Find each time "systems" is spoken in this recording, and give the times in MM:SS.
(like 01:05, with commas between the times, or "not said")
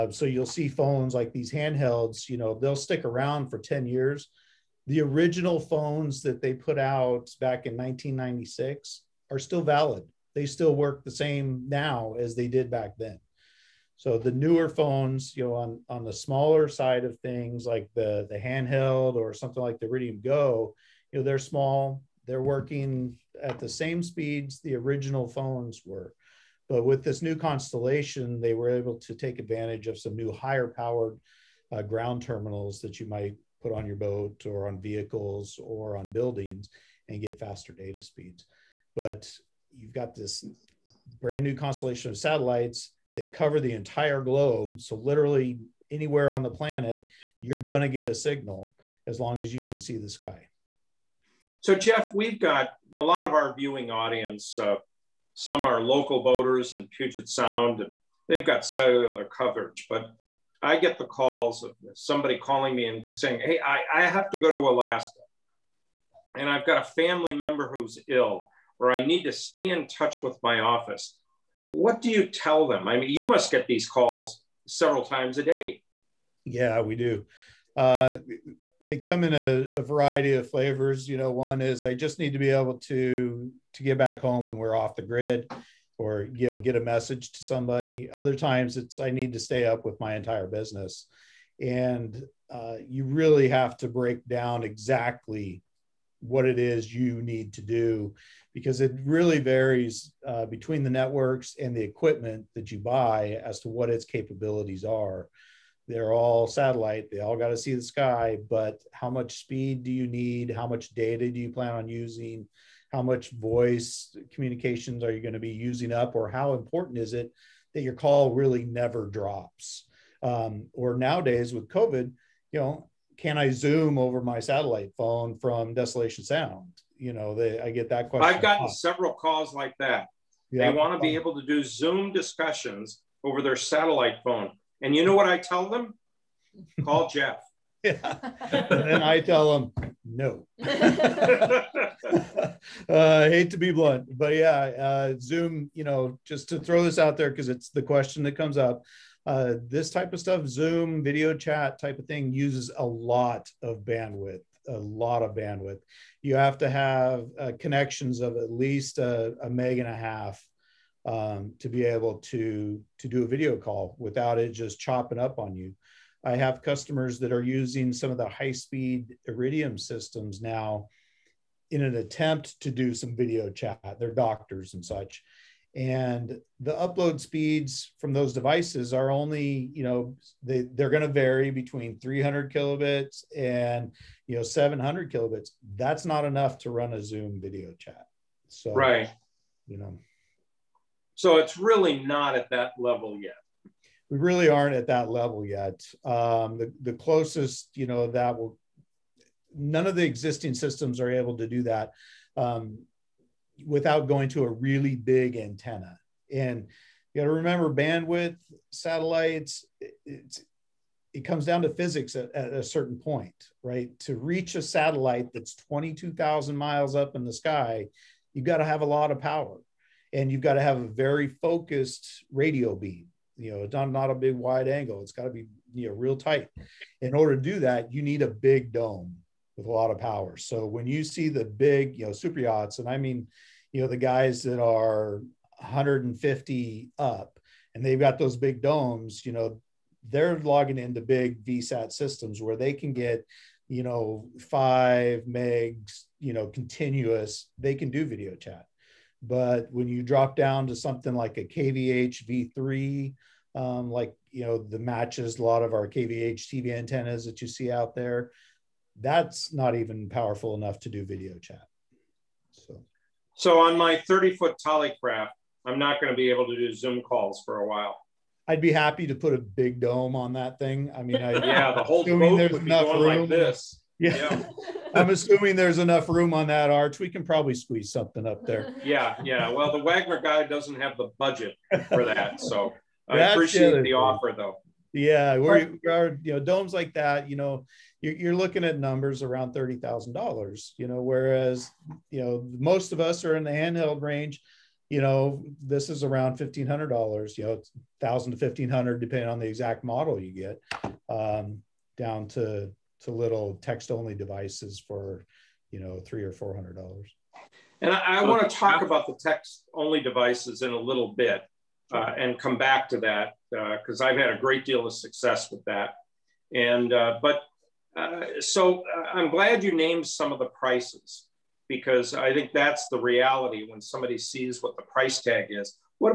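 02:49, 03:20, 04:01.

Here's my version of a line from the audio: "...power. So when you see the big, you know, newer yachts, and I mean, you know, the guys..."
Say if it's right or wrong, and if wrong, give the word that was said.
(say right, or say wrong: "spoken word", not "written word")
wrong: "super", not "newer".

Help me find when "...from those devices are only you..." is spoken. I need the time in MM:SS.
02:57.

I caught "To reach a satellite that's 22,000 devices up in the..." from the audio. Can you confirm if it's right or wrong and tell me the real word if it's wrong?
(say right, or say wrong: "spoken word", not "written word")
wrong: "miles", not "devices".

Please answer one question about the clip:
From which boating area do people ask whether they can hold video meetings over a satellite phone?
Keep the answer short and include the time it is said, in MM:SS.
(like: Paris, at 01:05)
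Desolation Sound, at 02:05.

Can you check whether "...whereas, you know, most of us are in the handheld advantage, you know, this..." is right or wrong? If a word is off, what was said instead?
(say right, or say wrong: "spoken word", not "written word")
wrong: "range", not "advantage".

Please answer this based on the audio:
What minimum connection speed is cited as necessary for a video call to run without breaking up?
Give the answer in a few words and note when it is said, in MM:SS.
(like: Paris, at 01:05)
1.5 megs, at 02:39.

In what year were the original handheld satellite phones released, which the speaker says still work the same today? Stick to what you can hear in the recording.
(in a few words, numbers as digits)
1996.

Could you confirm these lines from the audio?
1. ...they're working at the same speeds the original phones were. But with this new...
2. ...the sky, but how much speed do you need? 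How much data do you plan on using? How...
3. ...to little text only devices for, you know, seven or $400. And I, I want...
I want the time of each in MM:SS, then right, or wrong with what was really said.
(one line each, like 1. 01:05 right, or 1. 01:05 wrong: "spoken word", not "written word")
1. 00:22 right
2. 01:47 right
3. 05:03 wrong: "three", not "seven".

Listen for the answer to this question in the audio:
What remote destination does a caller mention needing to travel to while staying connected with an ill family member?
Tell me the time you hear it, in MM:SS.
01:04.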